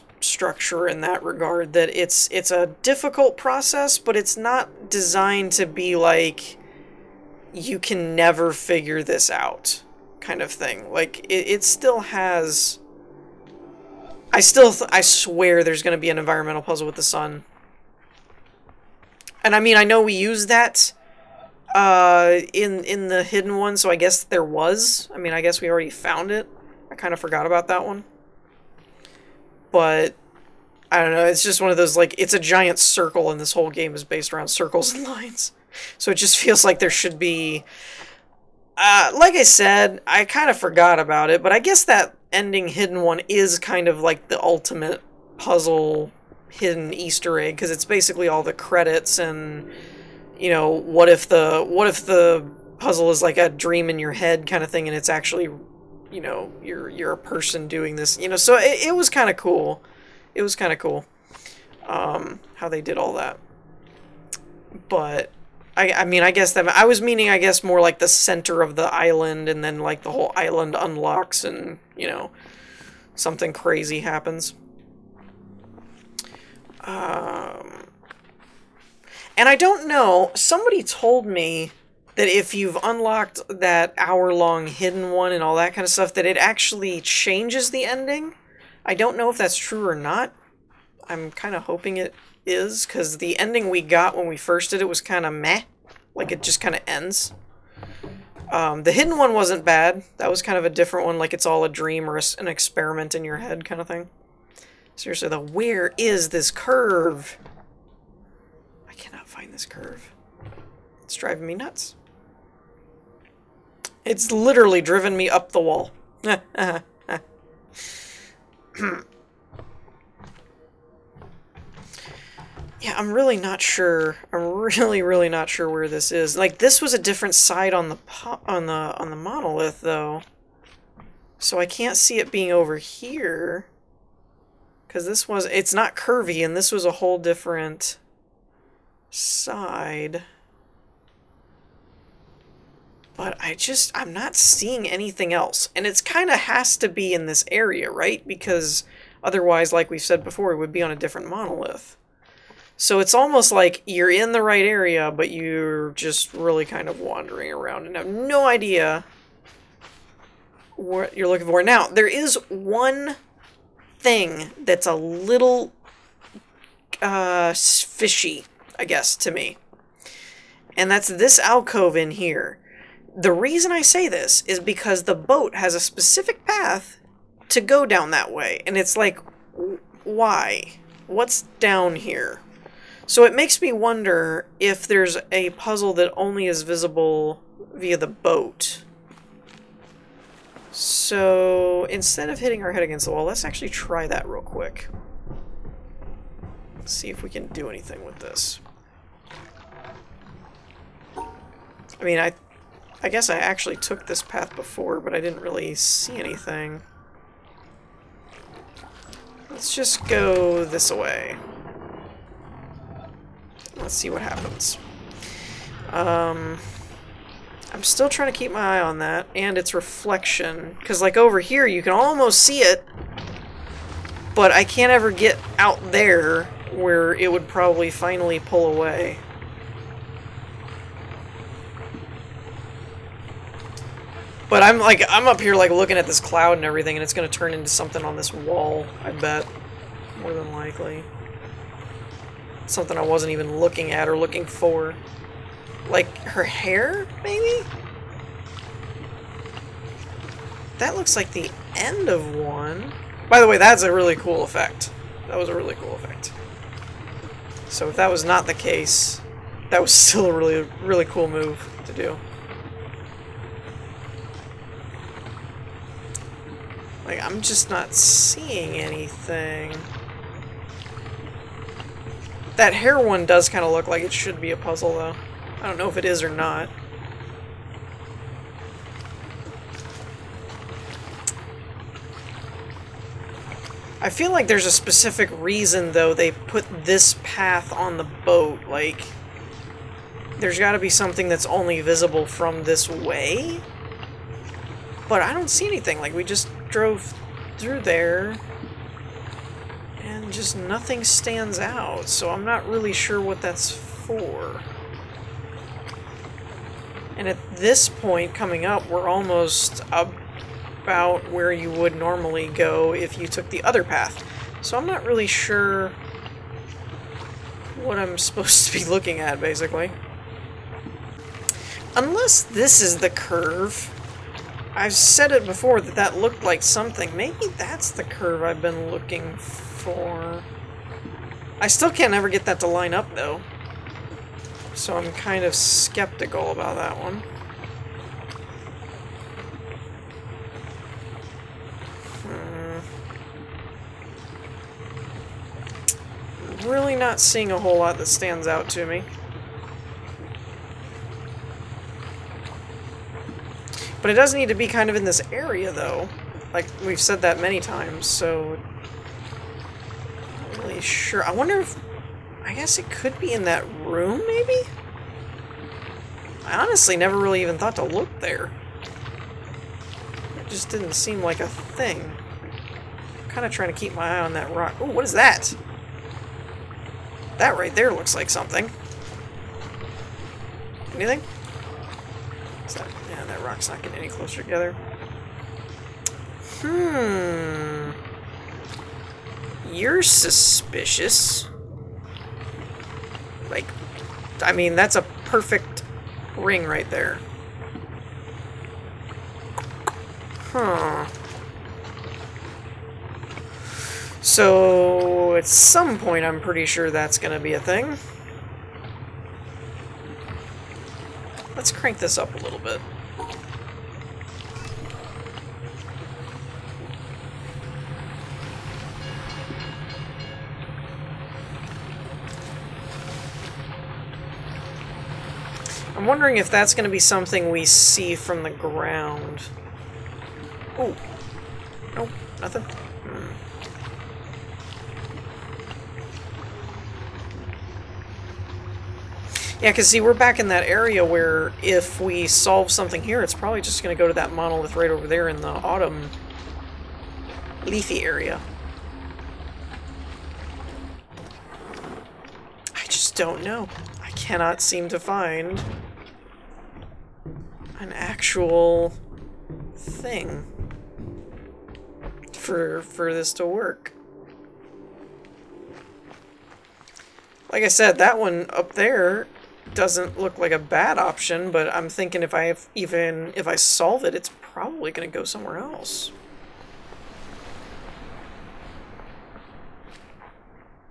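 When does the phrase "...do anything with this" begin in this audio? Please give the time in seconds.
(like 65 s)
197 s.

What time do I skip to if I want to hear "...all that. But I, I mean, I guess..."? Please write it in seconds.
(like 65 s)
62 s.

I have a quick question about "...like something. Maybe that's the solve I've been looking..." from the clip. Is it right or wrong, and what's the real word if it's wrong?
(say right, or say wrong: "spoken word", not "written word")
wrong: "curve", not "solve".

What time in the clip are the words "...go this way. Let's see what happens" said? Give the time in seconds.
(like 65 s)
210 s.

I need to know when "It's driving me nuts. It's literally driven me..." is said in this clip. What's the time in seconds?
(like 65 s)
111 s.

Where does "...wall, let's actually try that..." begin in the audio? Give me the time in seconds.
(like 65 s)
193 s.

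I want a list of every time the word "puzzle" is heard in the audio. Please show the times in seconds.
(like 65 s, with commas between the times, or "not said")
16 s, 45 s, 52 s, 185 s, 274 s.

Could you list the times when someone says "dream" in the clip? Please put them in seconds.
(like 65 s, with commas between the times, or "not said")
53 s, 101 s.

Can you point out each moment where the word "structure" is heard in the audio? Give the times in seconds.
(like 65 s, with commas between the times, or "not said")
0 s.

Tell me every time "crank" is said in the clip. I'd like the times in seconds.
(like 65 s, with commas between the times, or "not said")
411 s.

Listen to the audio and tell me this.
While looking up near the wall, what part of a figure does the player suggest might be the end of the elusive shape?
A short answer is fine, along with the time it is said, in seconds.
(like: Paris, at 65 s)
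Her hair, at 246 s.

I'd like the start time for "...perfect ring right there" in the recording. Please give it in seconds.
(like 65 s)
395 s.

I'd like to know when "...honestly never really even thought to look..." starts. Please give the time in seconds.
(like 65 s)
366 s.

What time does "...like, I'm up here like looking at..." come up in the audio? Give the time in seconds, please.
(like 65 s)
234 s.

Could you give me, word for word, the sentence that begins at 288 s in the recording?
Like, there's got to be something that's only visible from this way.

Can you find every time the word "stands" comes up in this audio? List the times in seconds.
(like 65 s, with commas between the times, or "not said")
301 s, 348 s.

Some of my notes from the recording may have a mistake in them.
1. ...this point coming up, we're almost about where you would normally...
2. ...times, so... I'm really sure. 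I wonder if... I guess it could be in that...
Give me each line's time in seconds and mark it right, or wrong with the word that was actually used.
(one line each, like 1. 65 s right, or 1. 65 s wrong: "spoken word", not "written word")
1. 307 s right
2. 357 s right.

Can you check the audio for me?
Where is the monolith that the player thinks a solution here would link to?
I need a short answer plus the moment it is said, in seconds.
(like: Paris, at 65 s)
Autumn leafy area, at 445 s.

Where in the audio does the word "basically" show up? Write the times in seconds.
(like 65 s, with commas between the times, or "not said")
47 s, 319 s.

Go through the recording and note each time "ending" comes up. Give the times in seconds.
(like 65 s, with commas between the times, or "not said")
42 s, 87 s, 93 s.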